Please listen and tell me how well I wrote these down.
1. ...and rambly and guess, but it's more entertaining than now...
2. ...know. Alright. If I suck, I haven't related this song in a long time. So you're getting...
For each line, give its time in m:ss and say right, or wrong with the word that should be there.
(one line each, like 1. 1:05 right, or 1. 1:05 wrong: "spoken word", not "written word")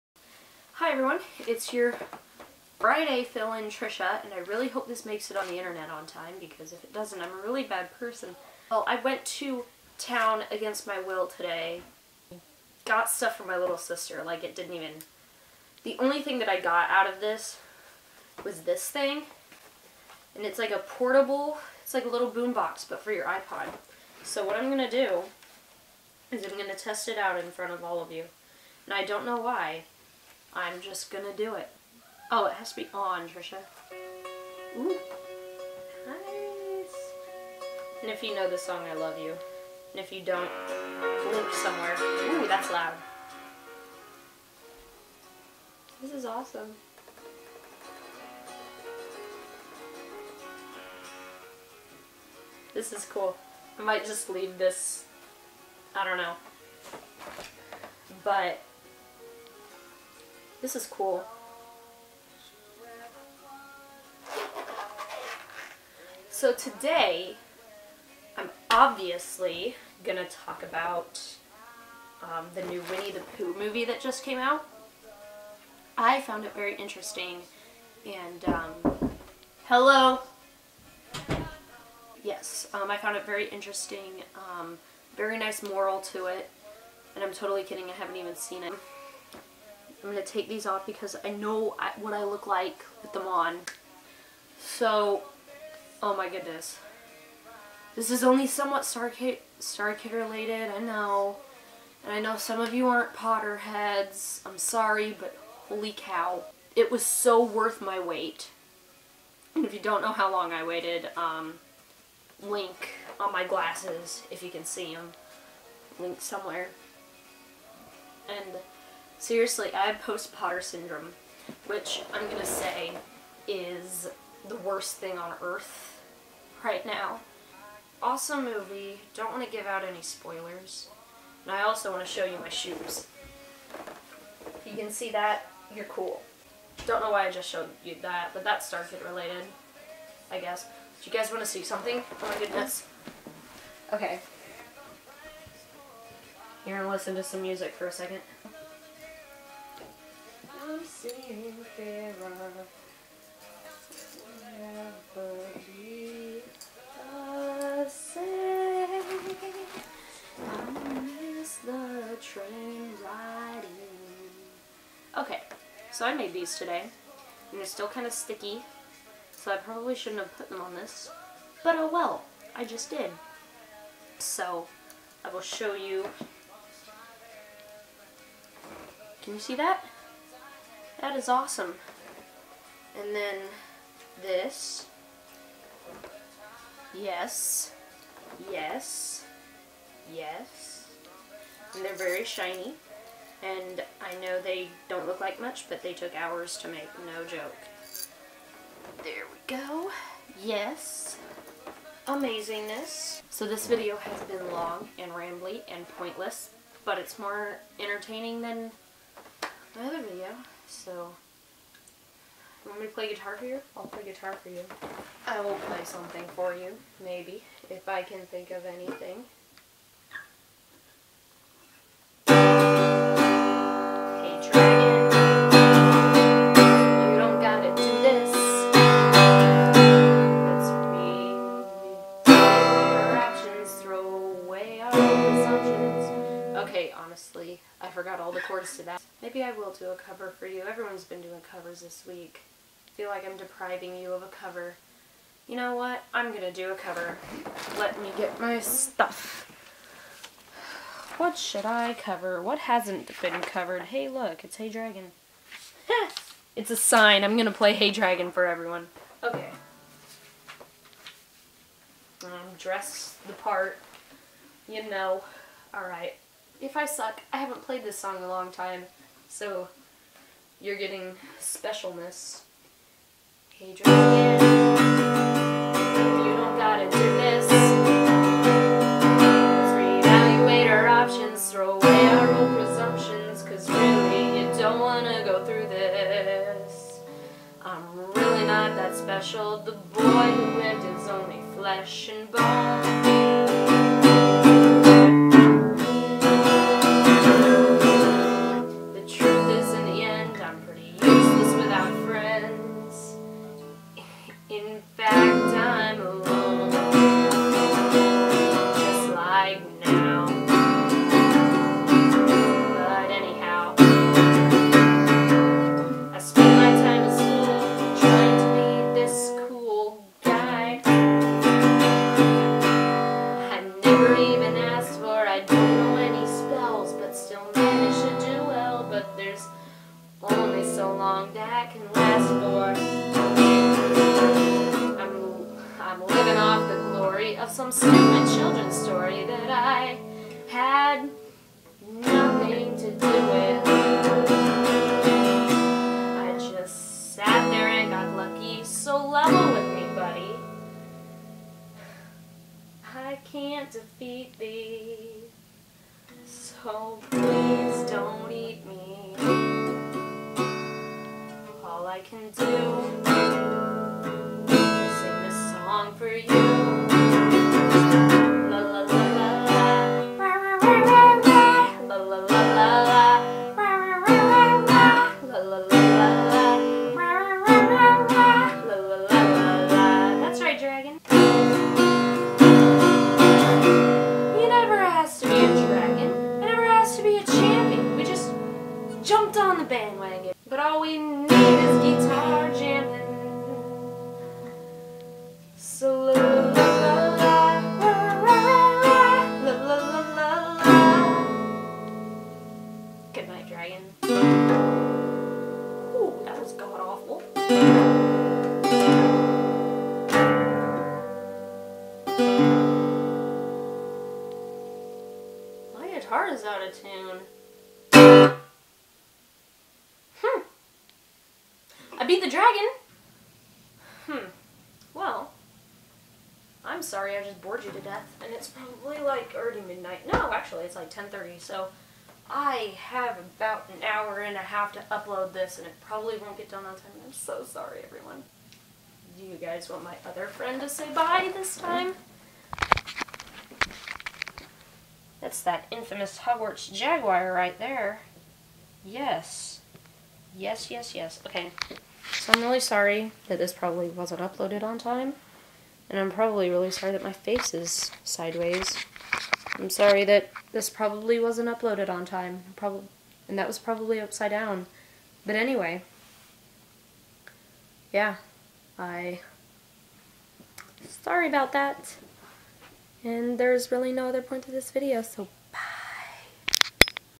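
1. 3:24 wrong: "pointless", not "guess"
2. 4:24 wrong: "played", not "related".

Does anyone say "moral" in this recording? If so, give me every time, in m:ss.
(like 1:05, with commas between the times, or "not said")
1:25.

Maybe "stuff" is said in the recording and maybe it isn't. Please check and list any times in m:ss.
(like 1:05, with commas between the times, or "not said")
0:13, 4:08.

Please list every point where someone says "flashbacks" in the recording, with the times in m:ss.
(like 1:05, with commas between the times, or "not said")
not said.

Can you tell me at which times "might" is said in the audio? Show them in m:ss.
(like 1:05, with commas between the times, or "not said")
0:53.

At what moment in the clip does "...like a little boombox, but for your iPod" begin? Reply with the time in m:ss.
0:21.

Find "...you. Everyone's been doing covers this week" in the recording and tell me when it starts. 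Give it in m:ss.
4:00.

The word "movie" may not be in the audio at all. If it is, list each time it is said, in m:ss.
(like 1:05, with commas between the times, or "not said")
1:13, 2:08.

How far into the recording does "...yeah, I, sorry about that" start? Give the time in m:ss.
7:47.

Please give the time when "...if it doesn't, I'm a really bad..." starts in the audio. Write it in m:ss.
0:06.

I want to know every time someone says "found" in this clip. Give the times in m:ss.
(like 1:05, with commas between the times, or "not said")
1:16, 1:22.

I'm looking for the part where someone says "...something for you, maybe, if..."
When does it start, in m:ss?
3:35.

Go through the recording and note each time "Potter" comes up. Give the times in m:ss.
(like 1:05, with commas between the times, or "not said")
1:43, 2:00.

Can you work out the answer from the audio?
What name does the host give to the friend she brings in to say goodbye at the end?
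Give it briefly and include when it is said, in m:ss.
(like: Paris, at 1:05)
Hogwarts Jaguar, at 7:26.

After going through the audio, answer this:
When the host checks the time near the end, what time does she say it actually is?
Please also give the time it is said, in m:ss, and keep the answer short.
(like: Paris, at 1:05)
10:30, at 7:10.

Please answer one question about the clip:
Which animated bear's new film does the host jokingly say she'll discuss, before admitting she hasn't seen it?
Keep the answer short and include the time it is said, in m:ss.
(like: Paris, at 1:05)
Winnie the Pooh, at 1:12.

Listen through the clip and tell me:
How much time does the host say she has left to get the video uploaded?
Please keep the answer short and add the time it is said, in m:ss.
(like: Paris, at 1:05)
an hour and a half, at 7:13.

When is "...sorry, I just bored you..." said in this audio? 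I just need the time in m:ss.
7:06.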